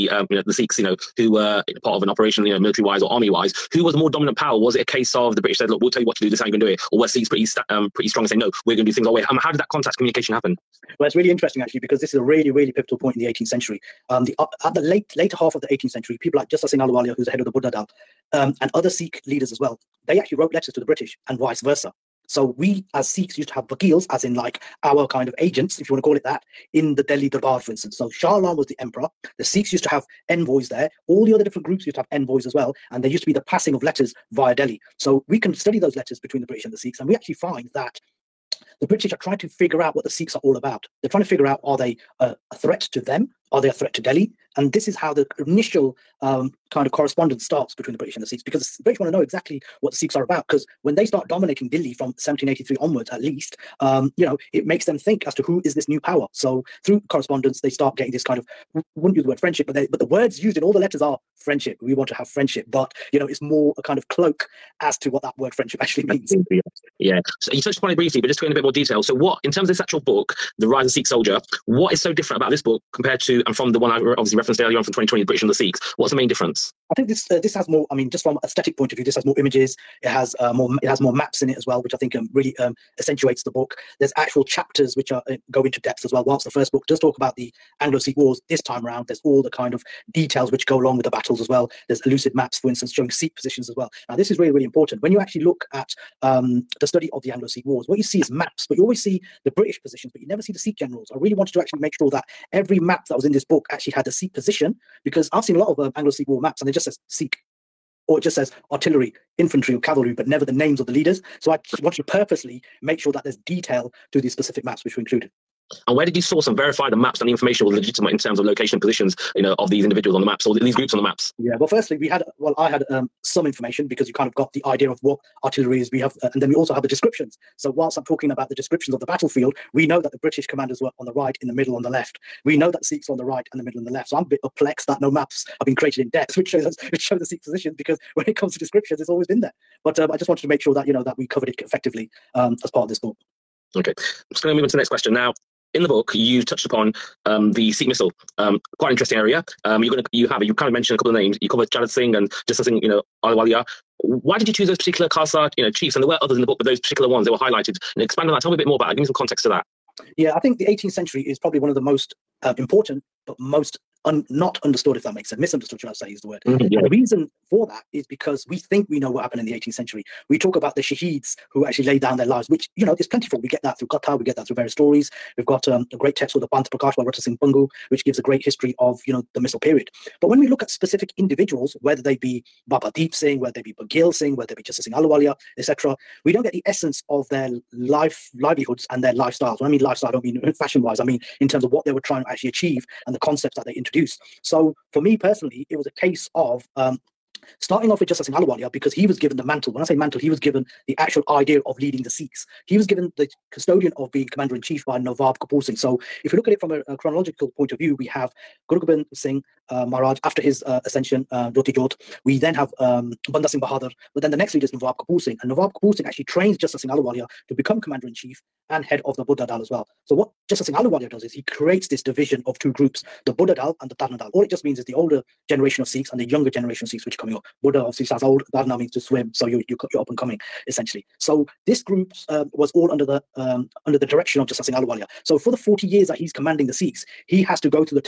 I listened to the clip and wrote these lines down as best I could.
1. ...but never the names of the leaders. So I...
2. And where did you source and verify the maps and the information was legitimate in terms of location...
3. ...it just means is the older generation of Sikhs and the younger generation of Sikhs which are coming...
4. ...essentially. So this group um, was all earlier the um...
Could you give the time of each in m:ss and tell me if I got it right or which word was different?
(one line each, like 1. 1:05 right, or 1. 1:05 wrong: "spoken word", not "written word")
1. 1:50 right
2. 1:55 right
3. 3:44 right
4. 3:50 wrong: "under", not "earlier".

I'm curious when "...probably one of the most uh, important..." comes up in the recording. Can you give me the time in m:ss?
2:41.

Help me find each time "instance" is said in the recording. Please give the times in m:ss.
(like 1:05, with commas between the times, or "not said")
0:27, 1:32.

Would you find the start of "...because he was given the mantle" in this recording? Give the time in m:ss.
3:18.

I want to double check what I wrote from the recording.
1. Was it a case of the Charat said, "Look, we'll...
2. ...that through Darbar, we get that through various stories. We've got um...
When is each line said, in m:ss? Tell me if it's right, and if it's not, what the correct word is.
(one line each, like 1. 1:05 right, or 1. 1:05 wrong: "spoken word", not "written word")
1. 0:04 wrong: "British", not "Charat"
2. 2:53 wrong: "Qatar", not "Darbar".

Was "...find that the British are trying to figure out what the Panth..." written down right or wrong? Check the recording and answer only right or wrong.
wrong.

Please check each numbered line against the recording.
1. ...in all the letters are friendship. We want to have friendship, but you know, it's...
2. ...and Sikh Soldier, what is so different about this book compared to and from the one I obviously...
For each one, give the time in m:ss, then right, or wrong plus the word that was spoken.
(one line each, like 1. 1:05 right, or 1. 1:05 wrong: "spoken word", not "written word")
1. 1:00 right
2. 1:10 right.